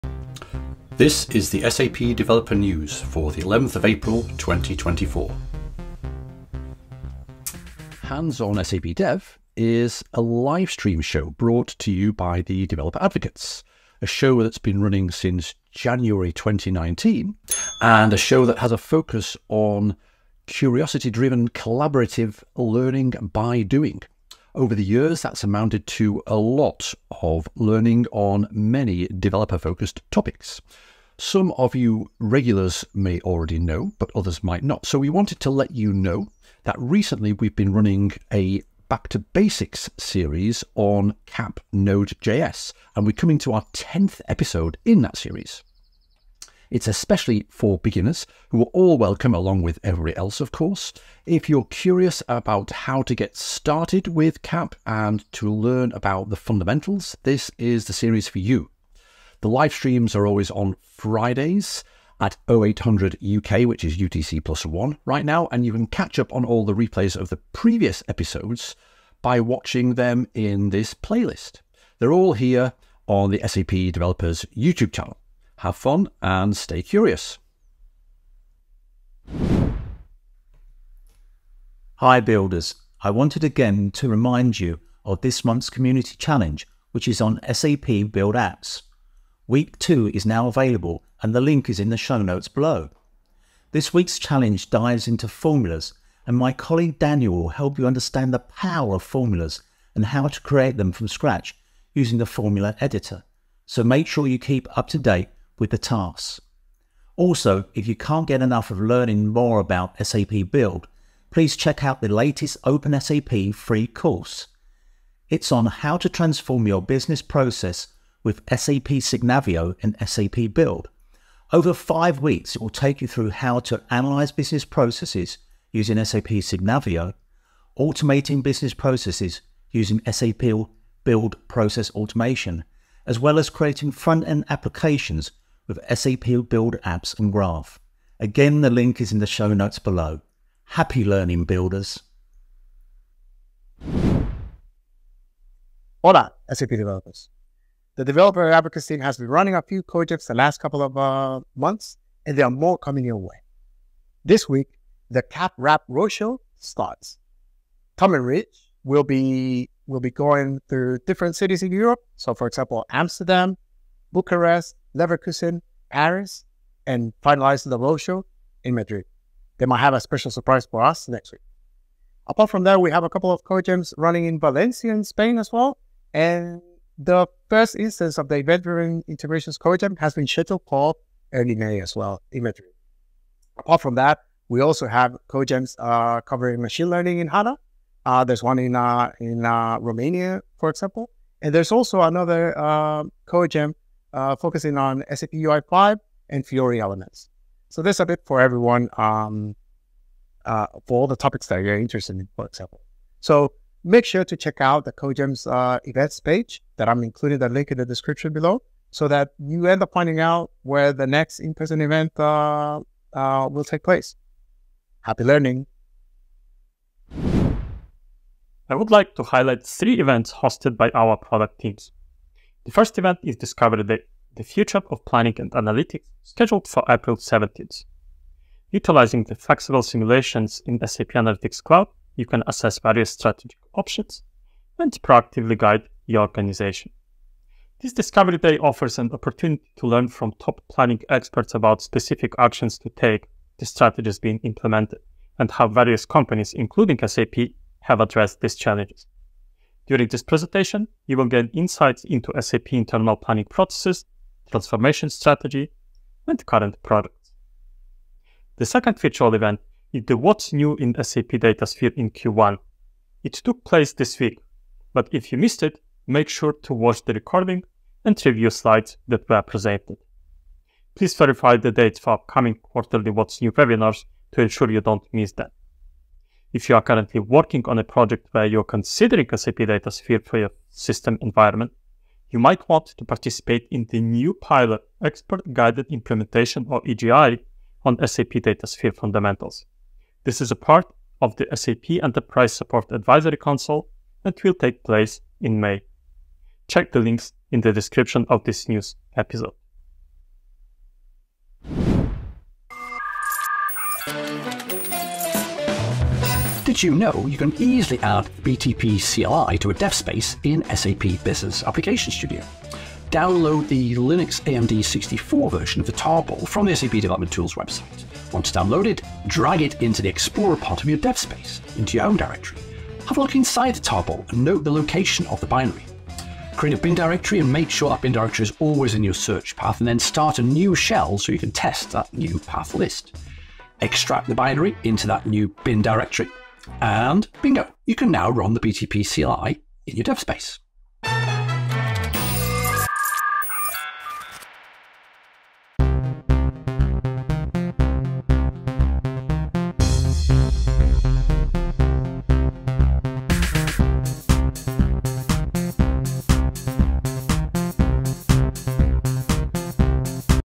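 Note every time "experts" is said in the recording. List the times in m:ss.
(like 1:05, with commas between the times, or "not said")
4:01, 4:45.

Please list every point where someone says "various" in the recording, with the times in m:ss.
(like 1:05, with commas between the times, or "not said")
3:52, 4:05.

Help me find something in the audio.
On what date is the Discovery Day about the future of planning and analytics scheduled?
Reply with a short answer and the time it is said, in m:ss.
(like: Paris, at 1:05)
April 17th, at 3:46.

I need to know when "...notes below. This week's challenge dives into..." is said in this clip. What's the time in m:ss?
1:32.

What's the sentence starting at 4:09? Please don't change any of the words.
During this presentation, you will gain insights into SAP internal planning processes, transformation strategy, and current products.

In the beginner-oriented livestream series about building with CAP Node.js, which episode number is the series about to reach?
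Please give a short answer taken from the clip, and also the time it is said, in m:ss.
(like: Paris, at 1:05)
10th, at 0:43.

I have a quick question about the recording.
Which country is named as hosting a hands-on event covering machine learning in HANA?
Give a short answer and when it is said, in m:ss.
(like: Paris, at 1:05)
Romania, at 3:09.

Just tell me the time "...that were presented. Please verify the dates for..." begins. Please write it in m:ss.
4:29.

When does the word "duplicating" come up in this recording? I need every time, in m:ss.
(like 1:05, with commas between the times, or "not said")
not said.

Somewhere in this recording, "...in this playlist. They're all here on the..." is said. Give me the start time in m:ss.
1:10.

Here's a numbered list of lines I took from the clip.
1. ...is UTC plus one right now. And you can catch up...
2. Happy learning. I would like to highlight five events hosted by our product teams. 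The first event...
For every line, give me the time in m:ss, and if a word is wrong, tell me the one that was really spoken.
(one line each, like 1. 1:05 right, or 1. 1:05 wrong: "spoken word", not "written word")
1. 1:03 right
2. 3:35 wrong: "three", not "five".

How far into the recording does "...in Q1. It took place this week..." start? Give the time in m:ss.
4:21.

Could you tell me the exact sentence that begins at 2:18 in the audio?
Again, the link is in the show notes below.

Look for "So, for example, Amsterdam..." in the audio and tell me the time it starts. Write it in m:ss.
2:42.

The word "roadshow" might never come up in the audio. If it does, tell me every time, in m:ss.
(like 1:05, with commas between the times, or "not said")
2:35, 2:47.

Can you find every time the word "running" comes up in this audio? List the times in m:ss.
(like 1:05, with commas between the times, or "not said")
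0:14, 0:37, 2:29, 2:53.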